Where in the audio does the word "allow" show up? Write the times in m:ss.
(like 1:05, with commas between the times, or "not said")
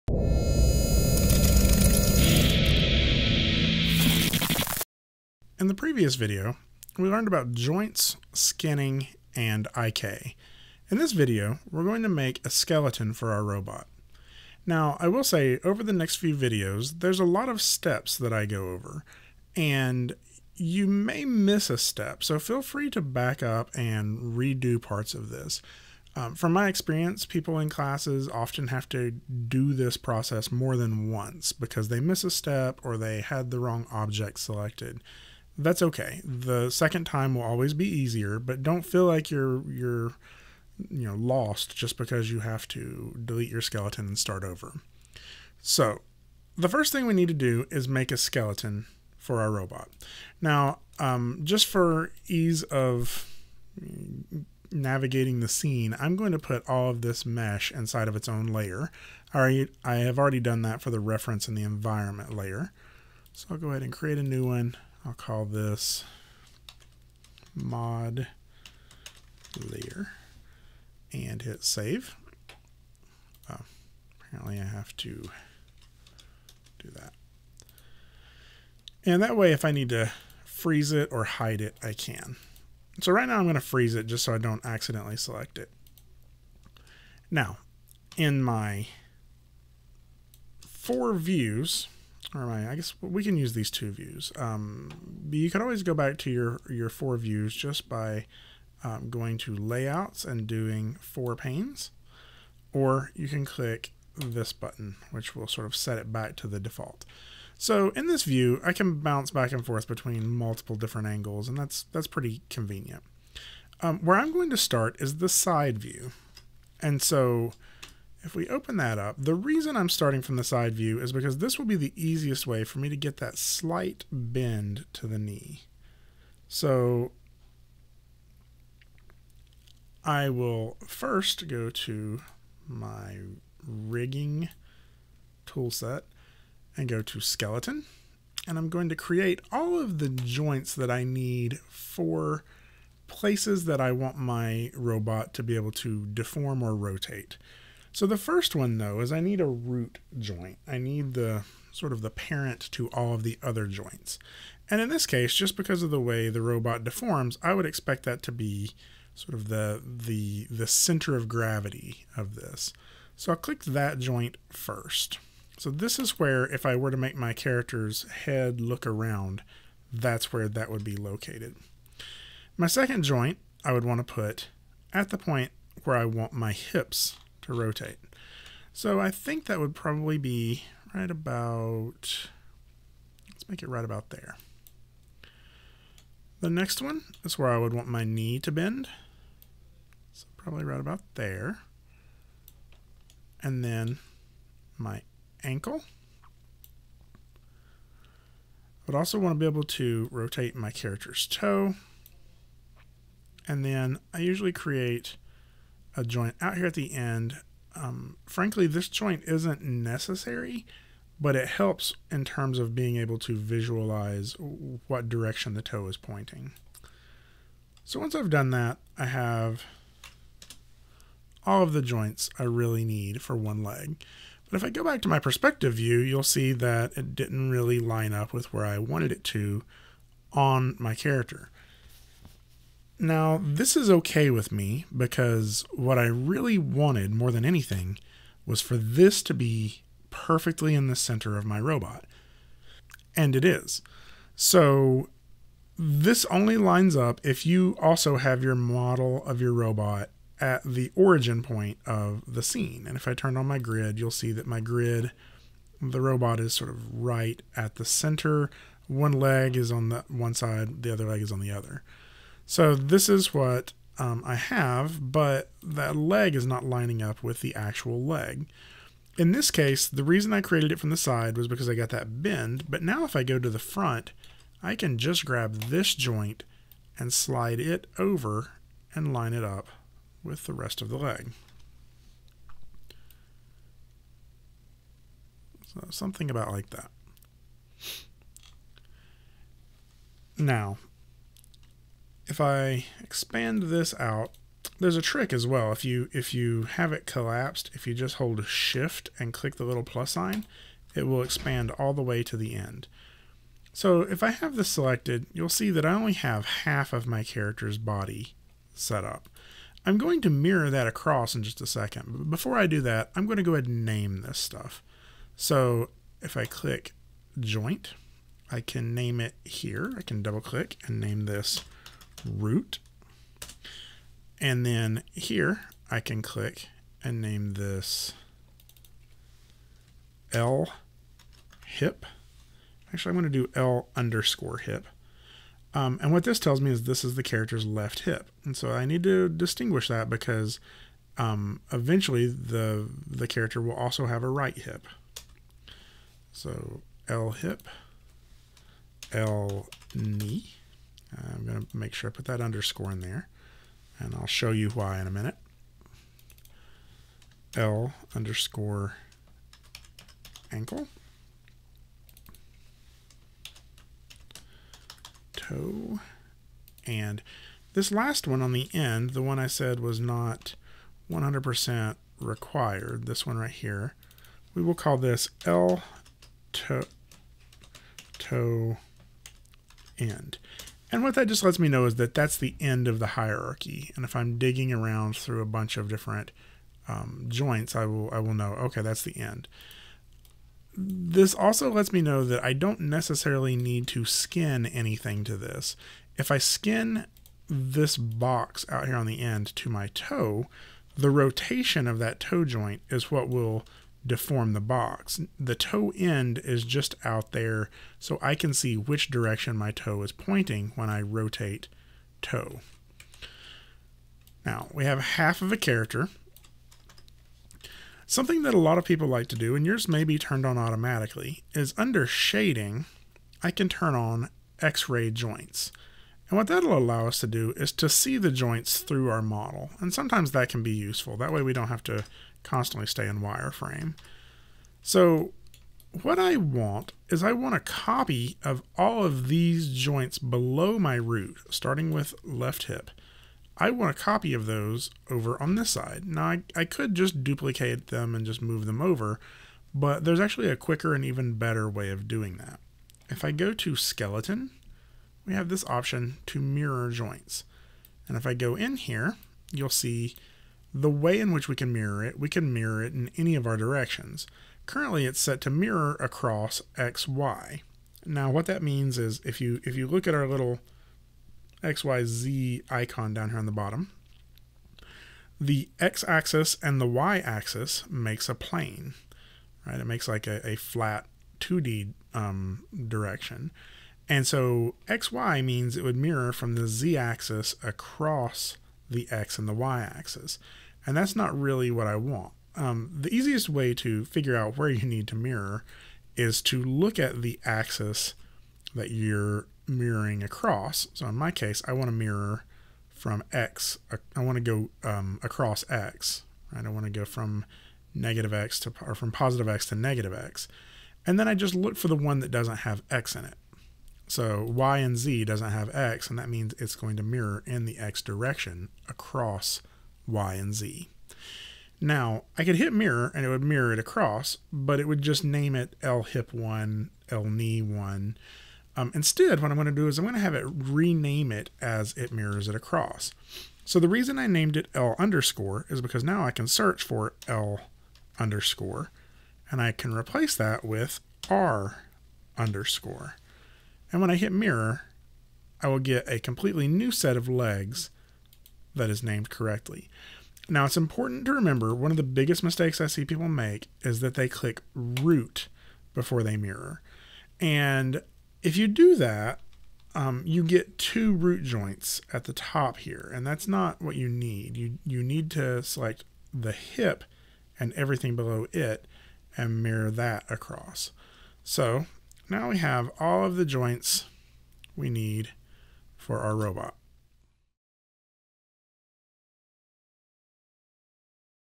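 7:06.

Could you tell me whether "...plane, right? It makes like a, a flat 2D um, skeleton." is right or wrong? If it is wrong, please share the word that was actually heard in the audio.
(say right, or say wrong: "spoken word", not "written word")
wrong: "direction", not "skeleton".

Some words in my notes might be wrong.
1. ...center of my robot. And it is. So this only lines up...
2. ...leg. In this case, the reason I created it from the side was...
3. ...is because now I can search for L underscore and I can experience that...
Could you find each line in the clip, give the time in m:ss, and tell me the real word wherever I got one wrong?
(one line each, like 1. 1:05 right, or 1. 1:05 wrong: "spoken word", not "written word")
1. 4:00 right
2. 4:28 right
3. 8:55 wrong: "replace", not "experience".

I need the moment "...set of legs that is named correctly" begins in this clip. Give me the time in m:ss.
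9:06.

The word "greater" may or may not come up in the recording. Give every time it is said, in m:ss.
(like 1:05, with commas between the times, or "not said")
not said.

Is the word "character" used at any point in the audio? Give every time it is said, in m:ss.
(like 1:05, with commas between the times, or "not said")
2:47, 3:20, 3:50, 5:07, 5:37, 5:43, 6:55.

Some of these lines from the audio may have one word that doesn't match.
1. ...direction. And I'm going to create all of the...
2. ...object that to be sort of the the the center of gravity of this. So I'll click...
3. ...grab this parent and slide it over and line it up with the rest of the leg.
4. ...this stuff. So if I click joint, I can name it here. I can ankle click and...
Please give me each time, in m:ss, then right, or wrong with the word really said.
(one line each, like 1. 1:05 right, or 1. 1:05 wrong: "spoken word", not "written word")
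1. 2:17 wrong: "skeleton", not "direction"
2. 2:37 wrong: "expect", not "object"
3. 4:35 wrong: "joint", not "parent"
4. 5:14 wrong: "double", not "ankle".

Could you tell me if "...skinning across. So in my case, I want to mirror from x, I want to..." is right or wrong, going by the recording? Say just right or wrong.
wrong.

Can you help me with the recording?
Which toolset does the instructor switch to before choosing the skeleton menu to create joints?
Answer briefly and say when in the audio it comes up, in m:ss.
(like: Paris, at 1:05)
rigging, at 2:13.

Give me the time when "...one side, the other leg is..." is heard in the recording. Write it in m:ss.
4:20.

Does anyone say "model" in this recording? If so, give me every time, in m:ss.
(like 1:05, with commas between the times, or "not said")
4:08, 7:09.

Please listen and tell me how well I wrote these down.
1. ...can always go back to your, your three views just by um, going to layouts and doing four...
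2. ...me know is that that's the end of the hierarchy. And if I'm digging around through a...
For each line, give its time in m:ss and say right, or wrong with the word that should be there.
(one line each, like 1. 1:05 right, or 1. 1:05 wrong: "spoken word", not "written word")
1. 1:35 wrong: "four", not "three"
2. 6:21 right.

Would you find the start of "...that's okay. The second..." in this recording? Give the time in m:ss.
0:35.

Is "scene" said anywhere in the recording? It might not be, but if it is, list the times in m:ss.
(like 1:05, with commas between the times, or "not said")
0:55, 4:12.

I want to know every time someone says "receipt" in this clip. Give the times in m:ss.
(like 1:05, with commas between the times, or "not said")
not said.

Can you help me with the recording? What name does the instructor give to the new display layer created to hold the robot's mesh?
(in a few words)
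mod layer.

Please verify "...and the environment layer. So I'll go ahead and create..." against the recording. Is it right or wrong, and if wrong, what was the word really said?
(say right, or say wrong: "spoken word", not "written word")
right.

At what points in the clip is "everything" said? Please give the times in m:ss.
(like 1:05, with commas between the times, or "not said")
9:27.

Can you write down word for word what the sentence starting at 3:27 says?
Um, frankly, this joint isn't necessary, but it helps in terms of being able to visualize what direction the toe is pointing.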